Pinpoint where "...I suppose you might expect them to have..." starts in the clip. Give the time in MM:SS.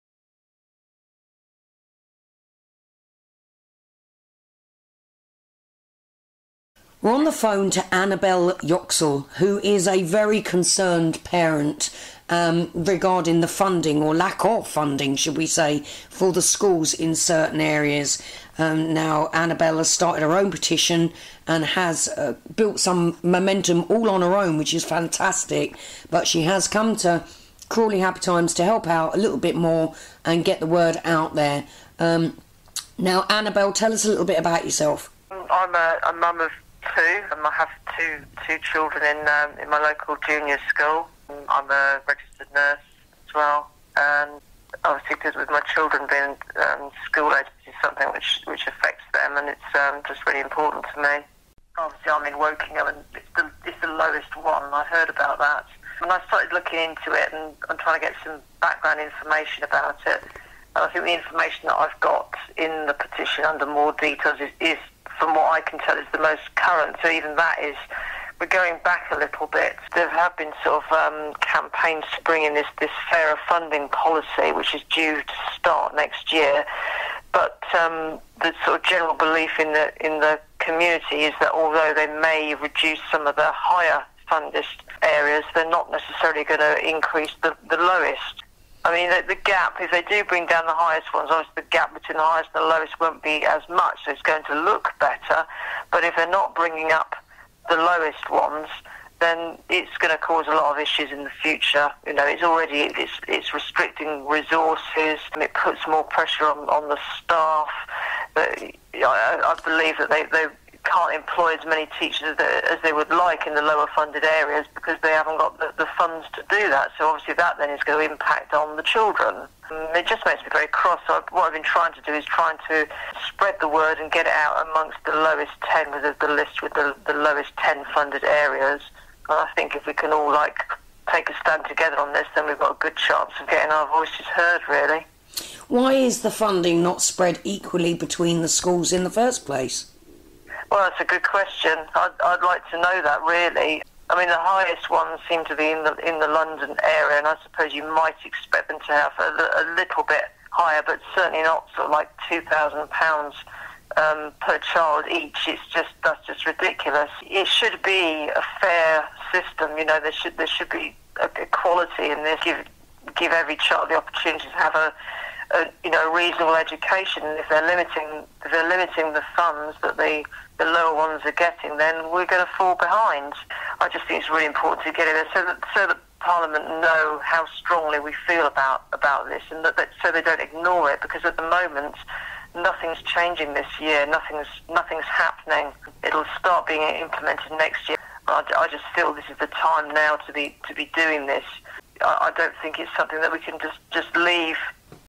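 02:27.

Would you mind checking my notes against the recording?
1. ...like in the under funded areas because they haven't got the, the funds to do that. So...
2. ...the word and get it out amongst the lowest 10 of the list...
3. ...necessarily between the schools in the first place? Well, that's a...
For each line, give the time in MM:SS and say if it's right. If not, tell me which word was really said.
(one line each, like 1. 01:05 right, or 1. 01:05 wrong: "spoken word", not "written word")
1. 01:53 wrong: "lower", not "under"
2. 02:03 right
3. 02:17 wrong: "equally", not "necessarily".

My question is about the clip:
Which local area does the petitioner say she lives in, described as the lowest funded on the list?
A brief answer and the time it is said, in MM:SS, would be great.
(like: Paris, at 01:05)
Wokingham, at 00:52.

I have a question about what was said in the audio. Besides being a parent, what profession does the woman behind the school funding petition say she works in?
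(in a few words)
Registered nurse.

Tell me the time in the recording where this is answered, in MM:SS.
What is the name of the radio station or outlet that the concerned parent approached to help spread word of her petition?
00:27.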